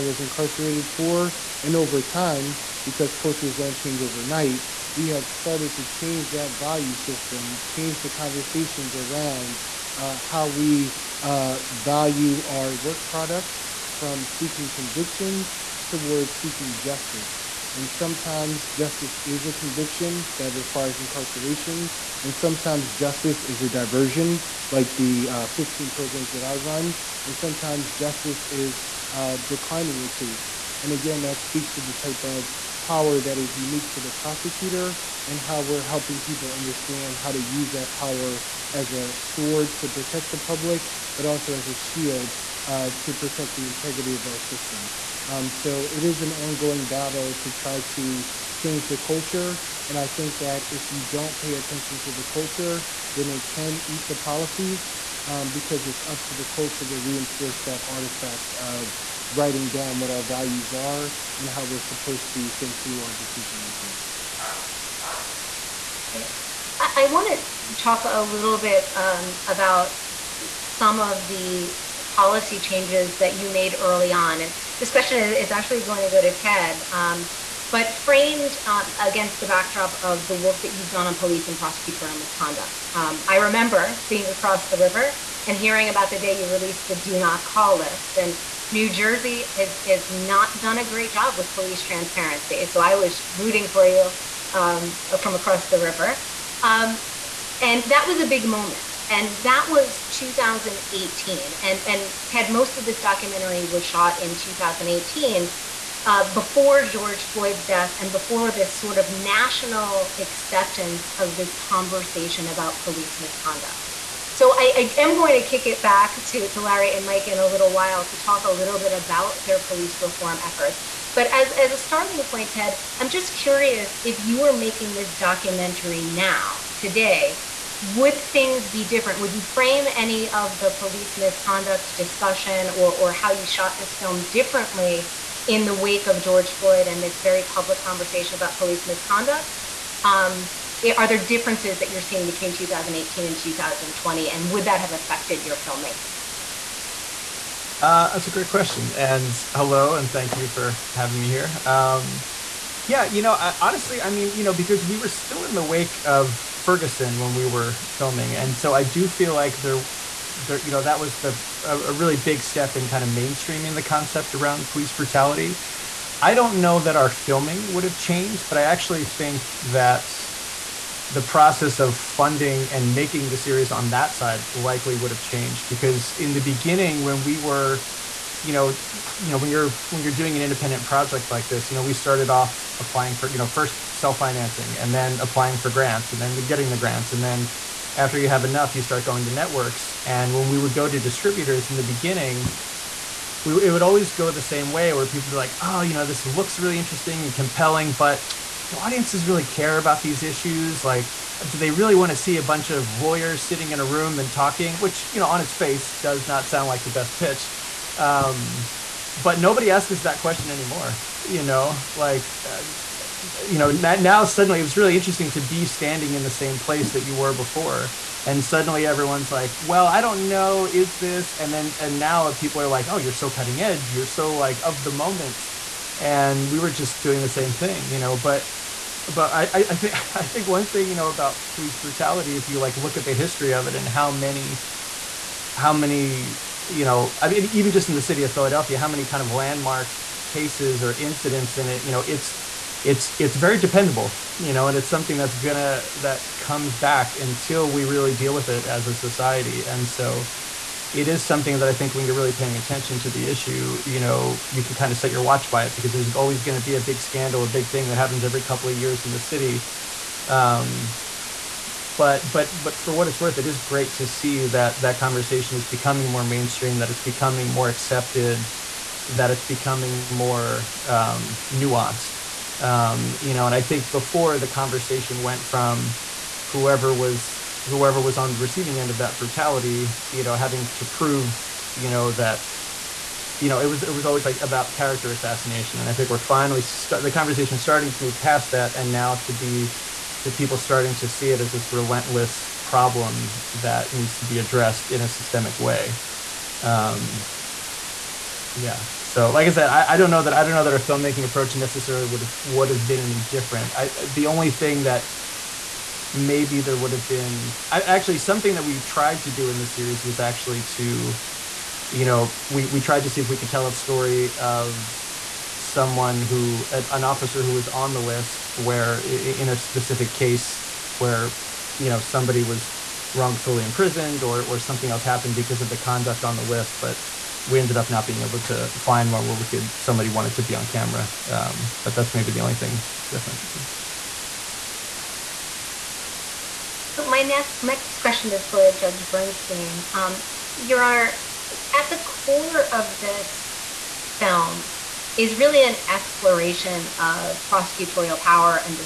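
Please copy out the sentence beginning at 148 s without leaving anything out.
And hello, and thank you for having me here.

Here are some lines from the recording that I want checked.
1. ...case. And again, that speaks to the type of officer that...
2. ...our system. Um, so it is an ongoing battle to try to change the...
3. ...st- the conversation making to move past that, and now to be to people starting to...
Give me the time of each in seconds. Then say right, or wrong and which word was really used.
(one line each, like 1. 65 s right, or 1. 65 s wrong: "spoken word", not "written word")
1. 30 s wrong: "power", not "officer"
2. 44 s right
3. 286 s wrong: "starting", not "making".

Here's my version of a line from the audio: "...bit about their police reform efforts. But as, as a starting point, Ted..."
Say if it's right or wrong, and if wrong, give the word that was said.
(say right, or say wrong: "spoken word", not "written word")
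right.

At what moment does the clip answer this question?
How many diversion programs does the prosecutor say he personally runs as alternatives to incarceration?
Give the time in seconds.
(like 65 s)
25 s.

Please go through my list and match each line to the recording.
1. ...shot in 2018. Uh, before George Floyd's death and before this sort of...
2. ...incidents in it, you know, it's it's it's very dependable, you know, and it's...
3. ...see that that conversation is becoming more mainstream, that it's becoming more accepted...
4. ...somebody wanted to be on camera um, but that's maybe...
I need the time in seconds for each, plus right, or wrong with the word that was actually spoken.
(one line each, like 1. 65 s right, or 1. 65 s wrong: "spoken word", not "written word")
1. 103 s right
2. 240 s right
3. 264 s right
4. 329 s right.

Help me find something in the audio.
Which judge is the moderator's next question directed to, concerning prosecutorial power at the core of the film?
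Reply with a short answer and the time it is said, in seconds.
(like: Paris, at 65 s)
Judge Bernstein, at 338 s.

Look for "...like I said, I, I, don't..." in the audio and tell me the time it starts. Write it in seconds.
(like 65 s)
299 s.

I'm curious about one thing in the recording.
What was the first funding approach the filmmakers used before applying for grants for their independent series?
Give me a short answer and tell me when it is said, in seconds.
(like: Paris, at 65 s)
self financing, at 183 s.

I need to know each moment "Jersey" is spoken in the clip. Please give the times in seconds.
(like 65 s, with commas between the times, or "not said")
88 s.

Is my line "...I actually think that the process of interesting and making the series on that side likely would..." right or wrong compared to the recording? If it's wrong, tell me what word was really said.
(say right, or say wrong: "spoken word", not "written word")
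wrong: "funding", not "interesting".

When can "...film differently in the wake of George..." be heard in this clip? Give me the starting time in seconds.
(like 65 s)
133 s.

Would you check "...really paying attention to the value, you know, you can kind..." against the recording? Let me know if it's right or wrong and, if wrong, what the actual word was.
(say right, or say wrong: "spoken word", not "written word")
wrong: "issue", not "value".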